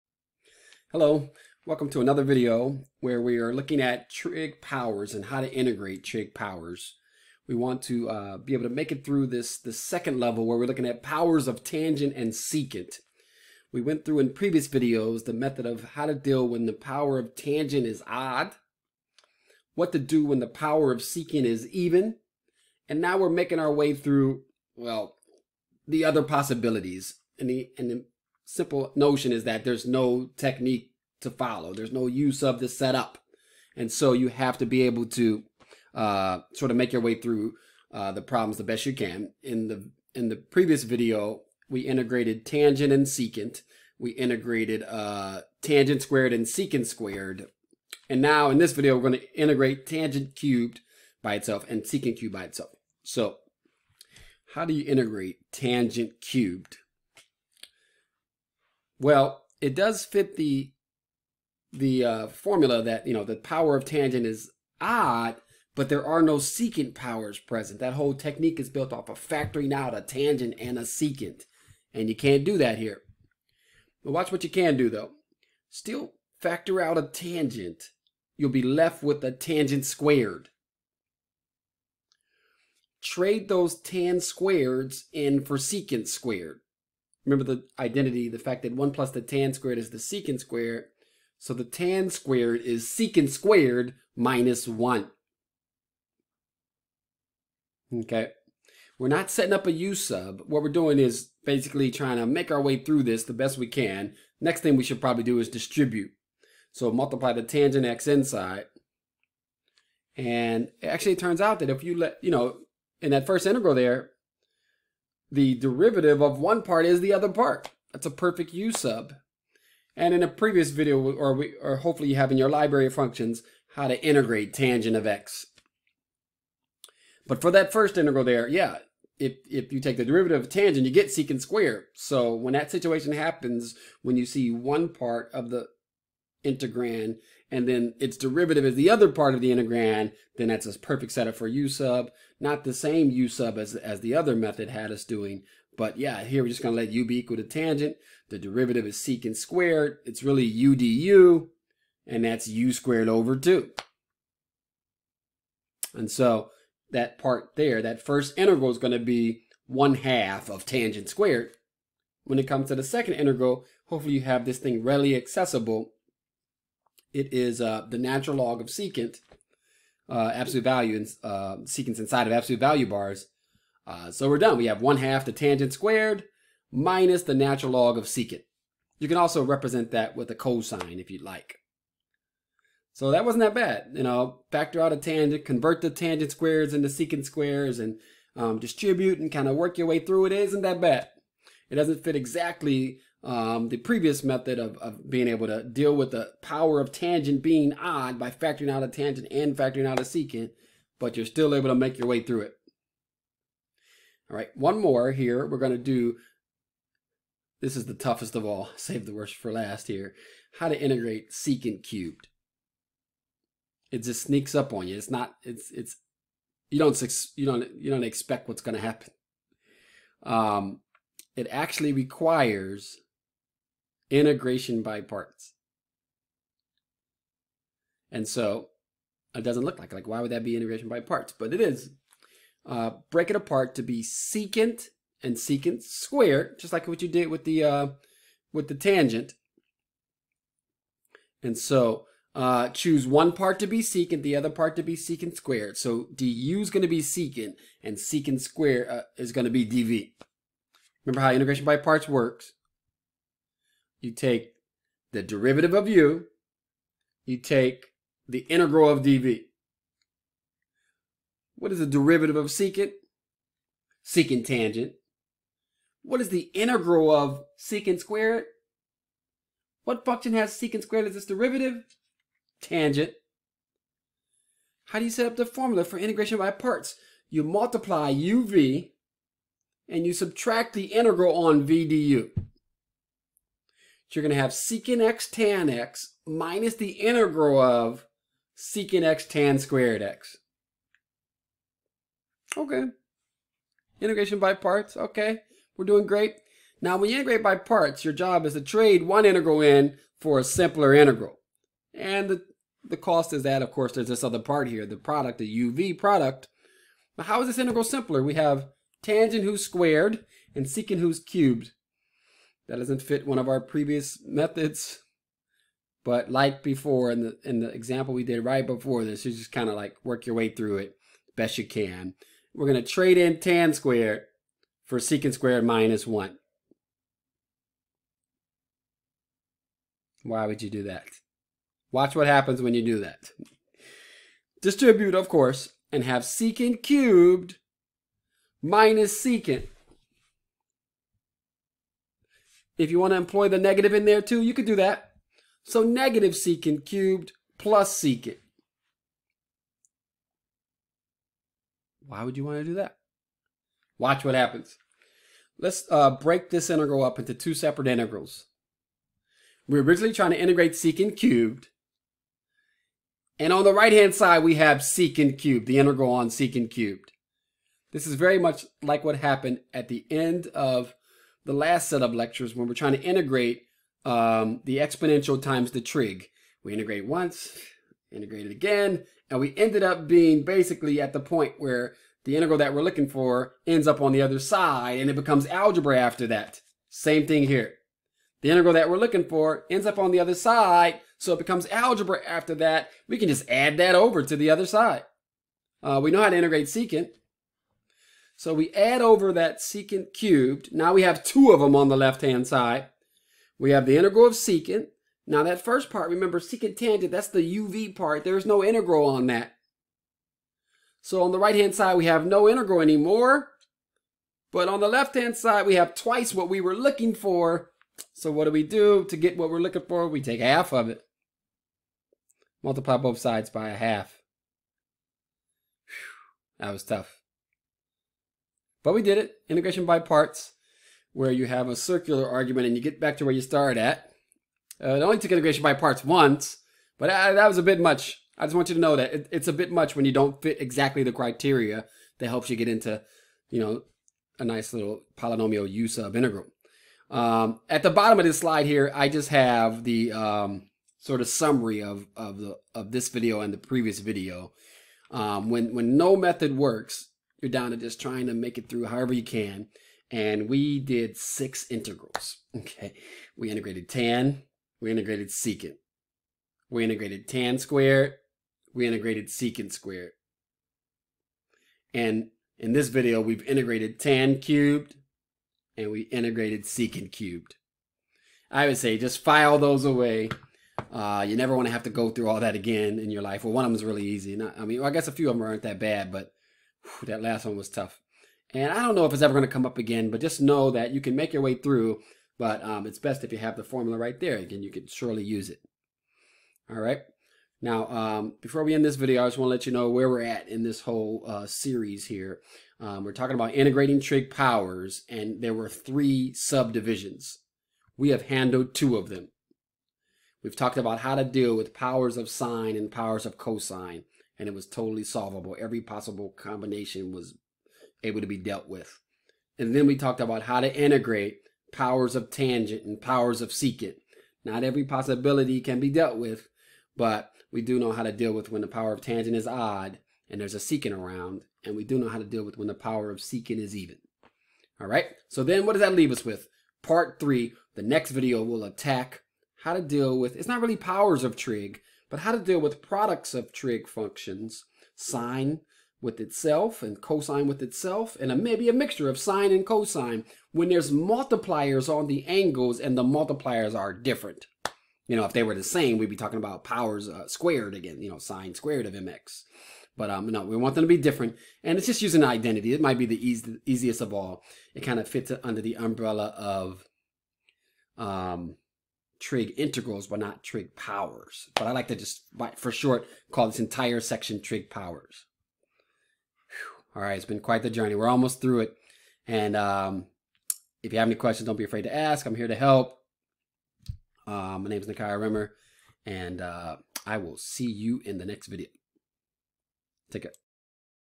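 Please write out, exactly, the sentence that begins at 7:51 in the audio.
And in this video, we've integrated tan cubed and we integrated secant cubed.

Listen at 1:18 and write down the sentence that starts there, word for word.
You'll be left with a tangent squared.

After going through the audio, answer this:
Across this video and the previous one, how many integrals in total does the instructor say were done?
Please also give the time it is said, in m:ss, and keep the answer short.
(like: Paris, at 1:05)
6, at 7:41.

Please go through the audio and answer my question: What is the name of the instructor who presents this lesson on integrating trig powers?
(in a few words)
Nakia Rimmer.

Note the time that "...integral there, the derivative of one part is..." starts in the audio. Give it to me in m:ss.
1:53.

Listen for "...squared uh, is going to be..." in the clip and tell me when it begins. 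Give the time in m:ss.
4:08.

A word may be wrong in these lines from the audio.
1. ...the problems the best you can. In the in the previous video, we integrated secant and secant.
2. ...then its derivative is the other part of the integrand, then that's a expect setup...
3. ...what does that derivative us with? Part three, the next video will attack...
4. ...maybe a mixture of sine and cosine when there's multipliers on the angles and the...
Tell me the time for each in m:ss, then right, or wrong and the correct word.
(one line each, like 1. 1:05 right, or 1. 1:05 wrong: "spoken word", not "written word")
1. 0:38 wrong: "tangent", not "secant"
2. 2:17 wrong: "perfect", not "expect"
3. 8:55 wrong: "leave", not "derivative"
4. 9:08 right.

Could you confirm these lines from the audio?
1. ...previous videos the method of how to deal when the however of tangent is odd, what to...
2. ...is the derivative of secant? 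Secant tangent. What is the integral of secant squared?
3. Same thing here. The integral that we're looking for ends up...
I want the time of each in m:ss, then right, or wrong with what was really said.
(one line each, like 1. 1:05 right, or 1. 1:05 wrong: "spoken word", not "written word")
1. 0:14 wrong: "power", not "however"
2. 4:21 right
3. 6:26 right.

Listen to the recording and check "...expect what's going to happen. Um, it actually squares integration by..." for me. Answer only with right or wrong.
wrong.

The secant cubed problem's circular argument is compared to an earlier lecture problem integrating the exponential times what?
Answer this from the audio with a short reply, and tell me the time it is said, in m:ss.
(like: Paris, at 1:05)
the trig, at 6:15.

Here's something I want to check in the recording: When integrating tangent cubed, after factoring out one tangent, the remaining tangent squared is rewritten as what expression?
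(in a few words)
secant squared minus 1.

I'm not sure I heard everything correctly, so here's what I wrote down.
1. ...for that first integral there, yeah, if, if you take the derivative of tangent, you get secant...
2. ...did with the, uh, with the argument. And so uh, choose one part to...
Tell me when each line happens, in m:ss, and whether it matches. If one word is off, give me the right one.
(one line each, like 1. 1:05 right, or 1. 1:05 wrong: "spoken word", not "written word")
1. 2:07 right
2. 3:57 wrong: "tangent", not "argument".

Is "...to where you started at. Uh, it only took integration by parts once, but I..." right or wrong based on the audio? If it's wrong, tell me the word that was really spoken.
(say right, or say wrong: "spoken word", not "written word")
right.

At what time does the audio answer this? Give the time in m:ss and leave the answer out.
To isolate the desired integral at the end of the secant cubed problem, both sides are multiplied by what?
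7:02.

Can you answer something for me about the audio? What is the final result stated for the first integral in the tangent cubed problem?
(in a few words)
1 half of tangent squared.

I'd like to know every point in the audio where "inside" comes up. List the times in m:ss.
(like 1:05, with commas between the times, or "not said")
1:48, 2:51.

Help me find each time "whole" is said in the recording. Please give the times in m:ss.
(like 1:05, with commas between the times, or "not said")
1:07, 8:20.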